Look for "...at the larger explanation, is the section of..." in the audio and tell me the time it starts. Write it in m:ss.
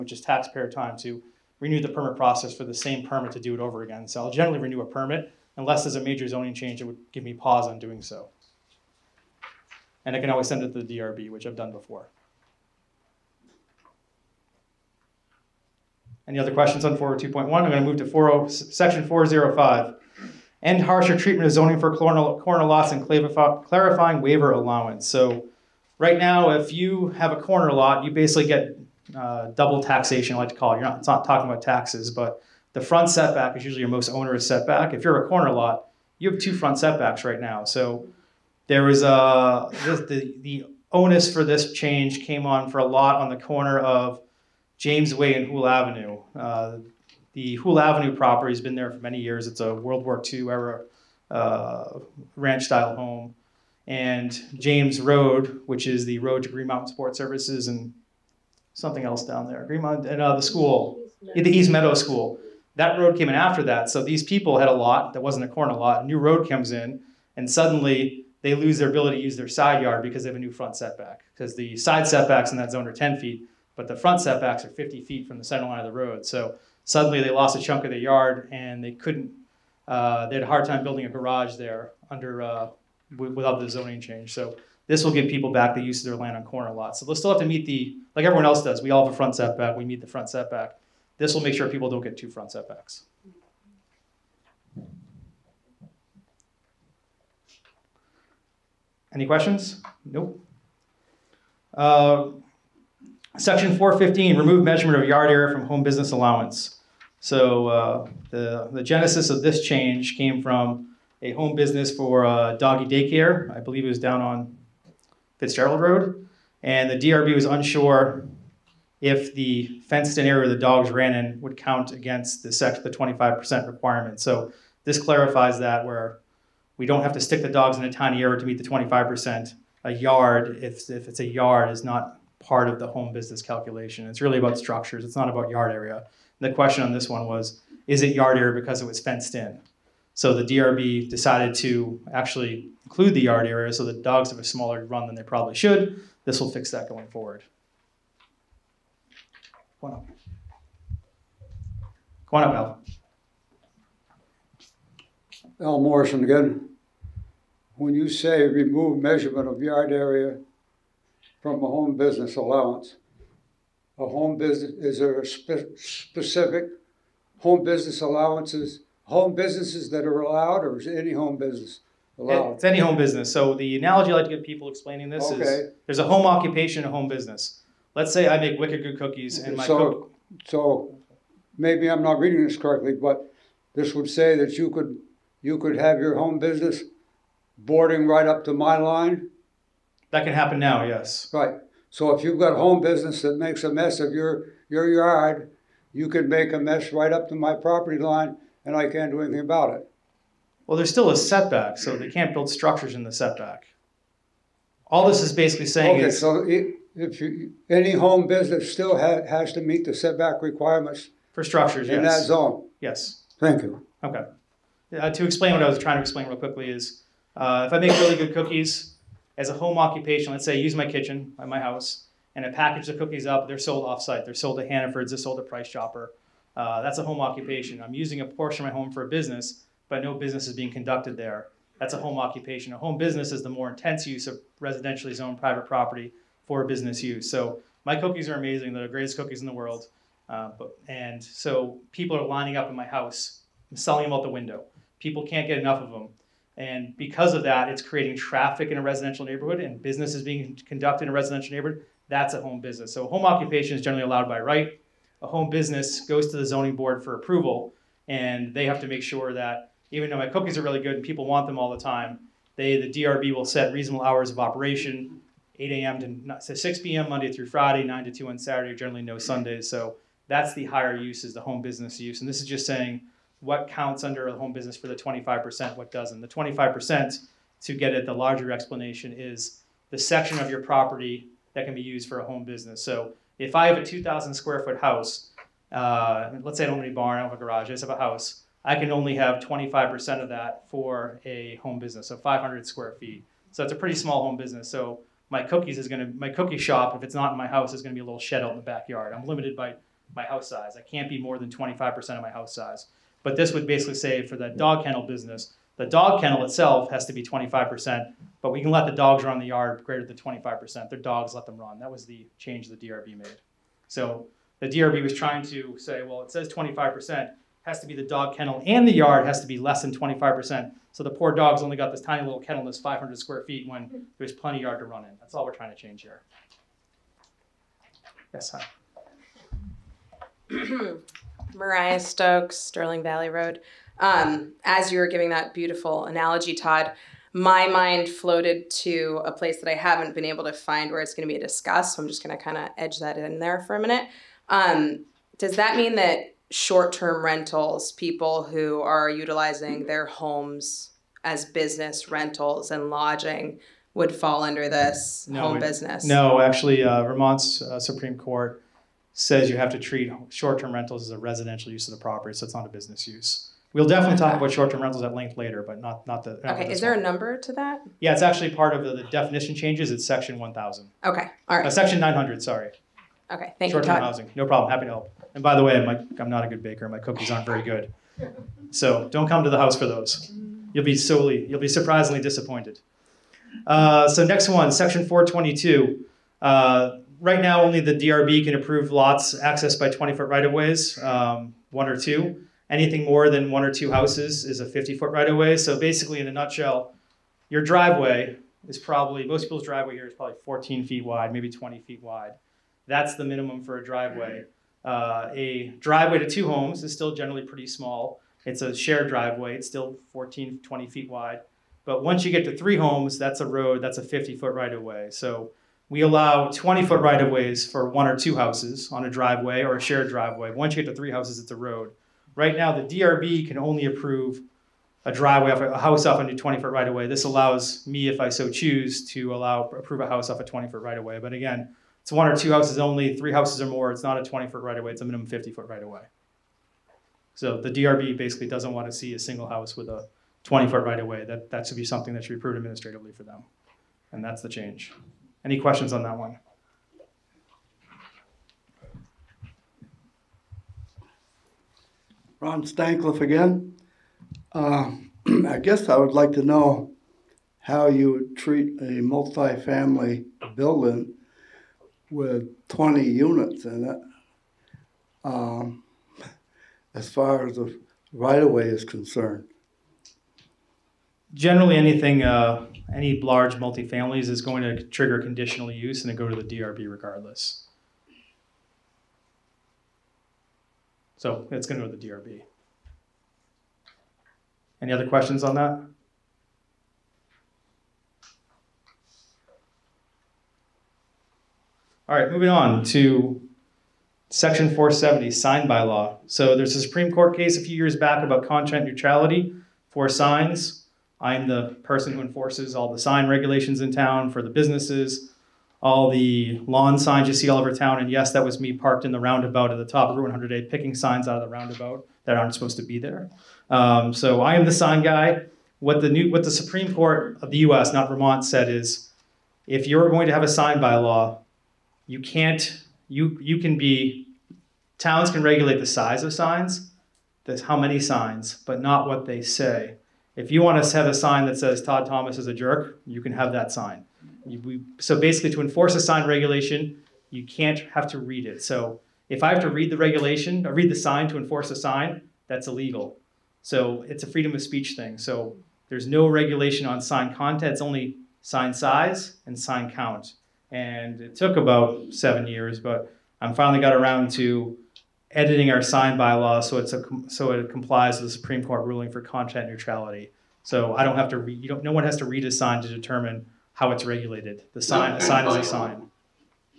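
4:37.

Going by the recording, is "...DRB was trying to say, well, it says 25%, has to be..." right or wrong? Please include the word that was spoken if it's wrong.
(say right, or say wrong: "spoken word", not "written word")
right.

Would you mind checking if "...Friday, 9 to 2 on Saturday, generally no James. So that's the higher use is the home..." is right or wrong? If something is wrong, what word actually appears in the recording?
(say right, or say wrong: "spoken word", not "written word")
wrong: "Sundays", not "James".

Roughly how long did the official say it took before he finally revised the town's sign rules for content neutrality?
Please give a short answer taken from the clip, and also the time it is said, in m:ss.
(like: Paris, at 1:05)
About 7 years, at 9:11.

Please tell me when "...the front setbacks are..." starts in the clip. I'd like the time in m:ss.
1:13.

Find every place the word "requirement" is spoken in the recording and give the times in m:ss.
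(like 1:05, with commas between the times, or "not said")
2:03, 3:30.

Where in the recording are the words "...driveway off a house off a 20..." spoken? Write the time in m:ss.
7:05.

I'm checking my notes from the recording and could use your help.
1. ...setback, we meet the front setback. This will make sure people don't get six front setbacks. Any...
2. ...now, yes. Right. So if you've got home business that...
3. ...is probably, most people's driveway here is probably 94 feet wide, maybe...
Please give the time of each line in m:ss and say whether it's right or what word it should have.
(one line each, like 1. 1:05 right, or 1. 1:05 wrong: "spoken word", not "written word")
1. 1:29 wrong: "two", not "six"
2. 3:10 right
3. 6:38 wrong: "14", not "94".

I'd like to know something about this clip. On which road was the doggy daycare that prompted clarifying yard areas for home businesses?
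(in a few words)
Fitzgerald Road.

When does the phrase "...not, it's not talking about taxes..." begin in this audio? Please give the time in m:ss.
0:30.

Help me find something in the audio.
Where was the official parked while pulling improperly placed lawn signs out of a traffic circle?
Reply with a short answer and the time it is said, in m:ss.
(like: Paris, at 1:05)
Route 108, at 8:30.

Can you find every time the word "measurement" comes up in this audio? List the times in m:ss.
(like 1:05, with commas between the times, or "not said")
1:44, 2:39.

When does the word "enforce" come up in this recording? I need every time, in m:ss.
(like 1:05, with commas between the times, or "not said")
8:22, 8:55, 9:01.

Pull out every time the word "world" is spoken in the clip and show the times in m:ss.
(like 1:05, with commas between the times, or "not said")
0:49, 3:59.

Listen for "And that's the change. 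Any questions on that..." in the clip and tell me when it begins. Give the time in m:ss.
7:24.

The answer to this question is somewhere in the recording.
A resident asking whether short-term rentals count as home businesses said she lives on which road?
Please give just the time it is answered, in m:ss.
5:32.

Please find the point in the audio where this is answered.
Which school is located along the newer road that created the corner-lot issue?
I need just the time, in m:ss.
1:01.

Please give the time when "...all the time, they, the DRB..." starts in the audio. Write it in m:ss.
4:21.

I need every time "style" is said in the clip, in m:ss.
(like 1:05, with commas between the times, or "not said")
0:52.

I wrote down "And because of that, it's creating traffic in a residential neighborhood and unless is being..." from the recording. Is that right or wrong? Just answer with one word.
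wrong.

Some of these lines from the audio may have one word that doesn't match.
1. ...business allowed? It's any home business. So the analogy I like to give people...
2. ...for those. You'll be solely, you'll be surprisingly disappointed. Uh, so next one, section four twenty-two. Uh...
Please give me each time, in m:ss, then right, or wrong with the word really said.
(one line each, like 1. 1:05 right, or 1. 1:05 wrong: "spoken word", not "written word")
1. 2:51 right
2. 6:19 right.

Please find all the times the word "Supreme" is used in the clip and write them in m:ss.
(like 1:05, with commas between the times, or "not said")
5:57, 8:16, 8:36, 9:18.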